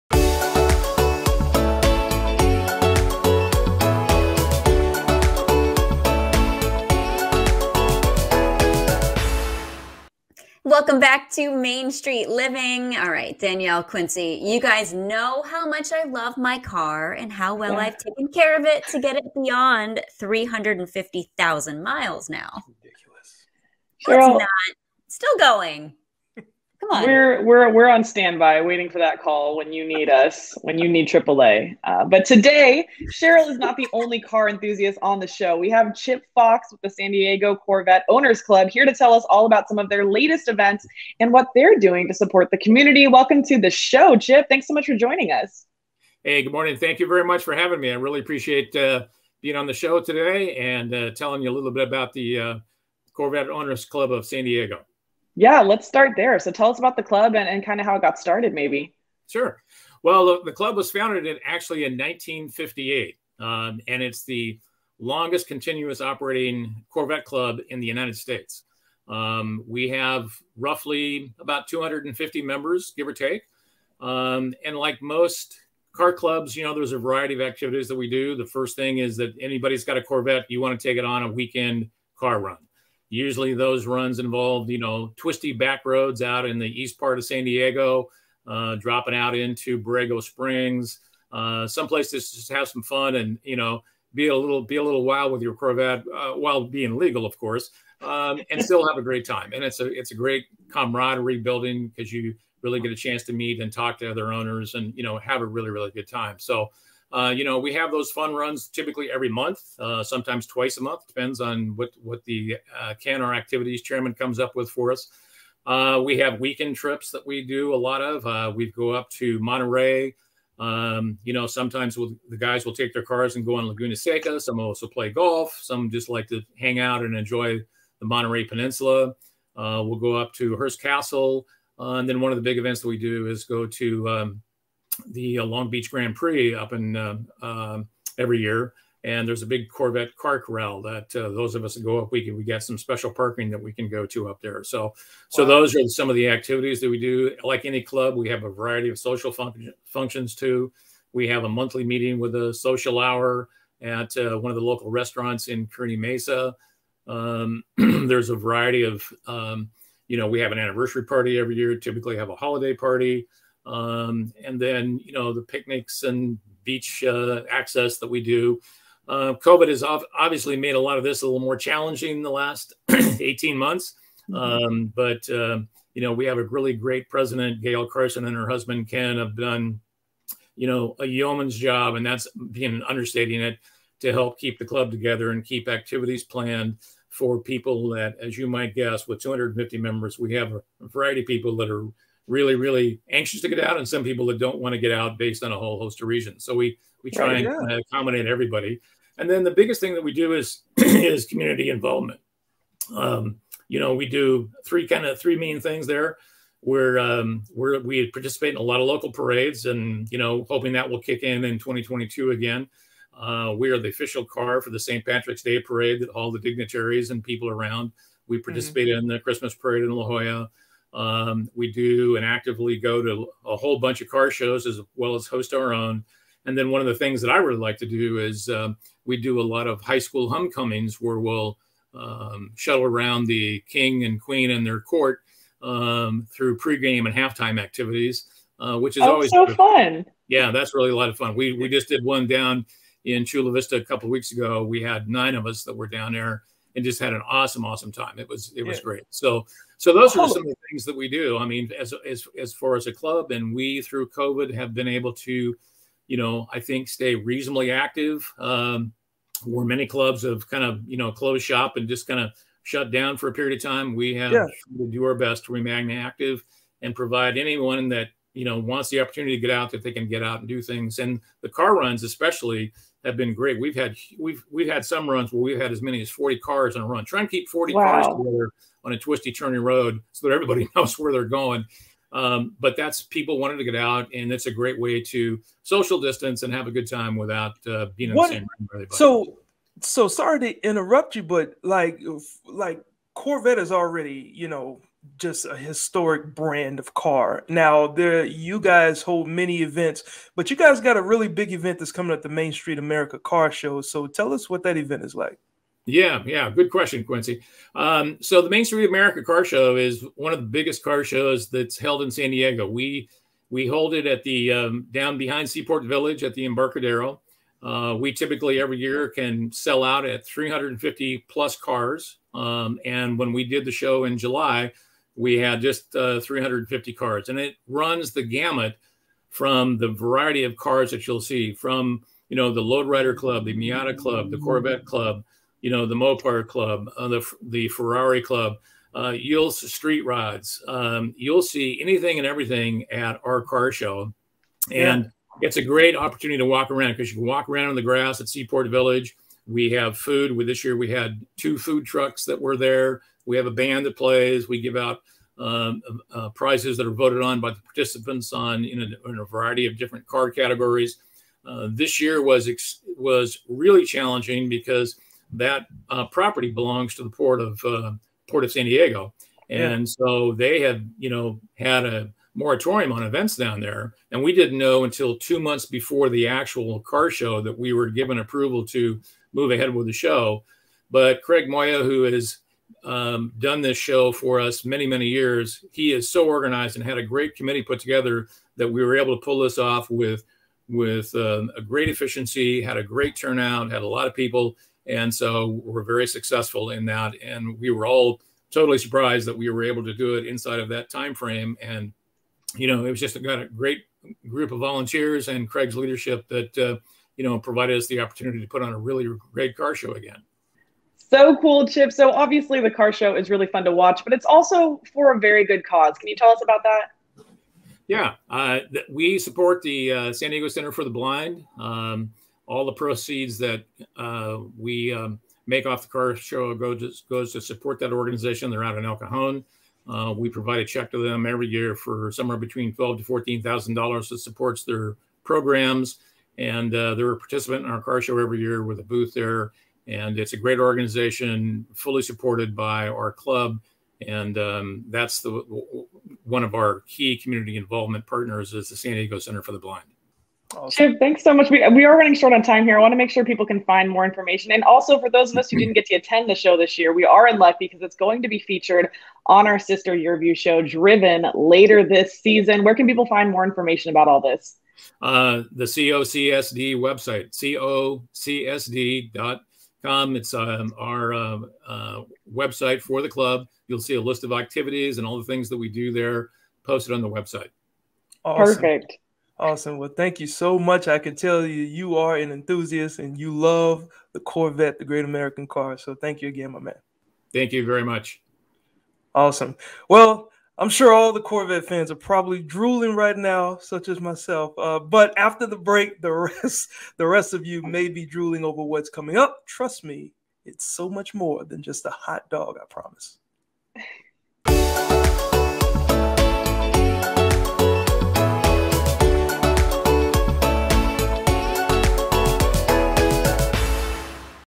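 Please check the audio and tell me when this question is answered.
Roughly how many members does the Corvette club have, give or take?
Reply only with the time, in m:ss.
1:11.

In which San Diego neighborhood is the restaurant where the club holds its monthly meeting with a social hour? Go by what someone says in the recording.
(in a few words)
Kearney Mesa.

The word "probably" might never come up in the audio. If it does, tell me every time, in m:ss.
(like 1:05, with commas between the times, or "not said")
8:11.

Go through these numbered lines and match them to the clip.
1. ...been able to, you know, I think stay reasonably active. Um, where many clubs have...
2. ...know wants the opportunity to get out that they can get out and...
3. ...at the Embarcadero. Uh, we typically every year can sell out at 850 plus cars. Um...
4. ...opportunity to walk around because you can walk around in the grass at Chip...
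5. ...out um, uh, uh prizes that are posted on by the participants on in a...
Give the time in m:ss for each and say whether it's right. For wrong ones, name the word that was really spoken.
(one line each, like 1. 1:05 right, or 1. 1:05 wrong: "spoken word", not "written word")
1. 4:14 right
2. 4:28 right
3. 5:16 wrong: "350", not "850"
4. 5:45 wrong: "Seaport", not "Chip"
5. 5:54 wrong: "voted", not "posted".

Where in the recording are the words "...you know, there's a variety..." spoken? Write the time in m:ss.
1:16.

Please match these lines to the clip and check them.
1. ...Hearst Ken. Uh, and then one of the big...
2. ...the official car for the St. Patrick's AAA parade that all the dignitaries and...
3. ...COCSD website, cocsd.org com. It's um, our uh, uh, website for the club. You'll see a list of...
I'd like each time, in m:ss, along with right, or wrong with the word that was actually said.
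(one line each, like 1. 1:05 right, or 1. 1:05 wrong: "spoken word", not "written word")
1. 2:10 wrong: "Castle", not "Ken"
2. 3:33 wrong: "Day", not "AAA"
3. 7:45 right.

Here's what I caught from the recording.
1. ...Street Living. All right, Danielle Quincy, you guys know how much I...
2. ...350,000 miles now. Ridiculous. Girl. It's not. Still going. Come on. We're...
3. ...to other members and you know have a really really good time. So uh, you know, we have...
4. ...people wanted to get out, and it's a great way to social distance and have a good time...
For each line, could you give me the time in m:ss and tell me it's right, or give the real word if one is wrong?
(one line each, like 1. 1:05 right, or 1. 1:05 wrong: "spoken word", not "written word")
1. 0:11 right
2. 0:20 right
3. 1:43 wrong: "owners", not "members"
4. 4:43 right.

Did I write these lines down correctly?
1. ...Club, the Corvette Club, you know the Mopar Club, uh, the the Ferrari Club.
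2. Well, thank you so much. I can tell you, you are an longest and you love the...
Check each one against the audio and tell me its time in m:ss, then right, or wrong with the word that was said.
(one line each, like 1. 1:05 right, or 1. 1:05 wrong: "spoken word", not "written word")
1. 5:33 right
2. 7:59 wrong: "enthusiast", not "longest".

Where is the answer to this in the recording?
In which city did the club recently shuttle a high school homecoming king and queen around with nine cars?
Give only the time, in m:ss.
4:03.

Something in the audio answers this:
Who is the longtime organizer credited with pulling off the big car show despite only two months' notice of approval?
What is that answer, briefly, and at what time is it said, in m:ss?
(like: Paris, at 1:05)
Craig Moya, at 6:21.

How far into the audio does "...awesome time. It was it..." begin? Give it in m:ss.
4:07.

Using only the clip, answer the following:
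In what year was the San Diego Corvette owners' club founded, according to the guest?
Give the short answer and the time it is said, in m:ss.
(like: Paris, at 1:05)
1958, at 1:01.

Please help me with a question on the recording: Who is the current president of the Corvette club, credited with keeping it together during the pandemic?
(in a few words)
Gail Carson.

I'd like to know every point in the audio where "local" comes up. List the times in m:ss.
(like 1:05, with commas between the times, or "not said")
2:34, 3:28.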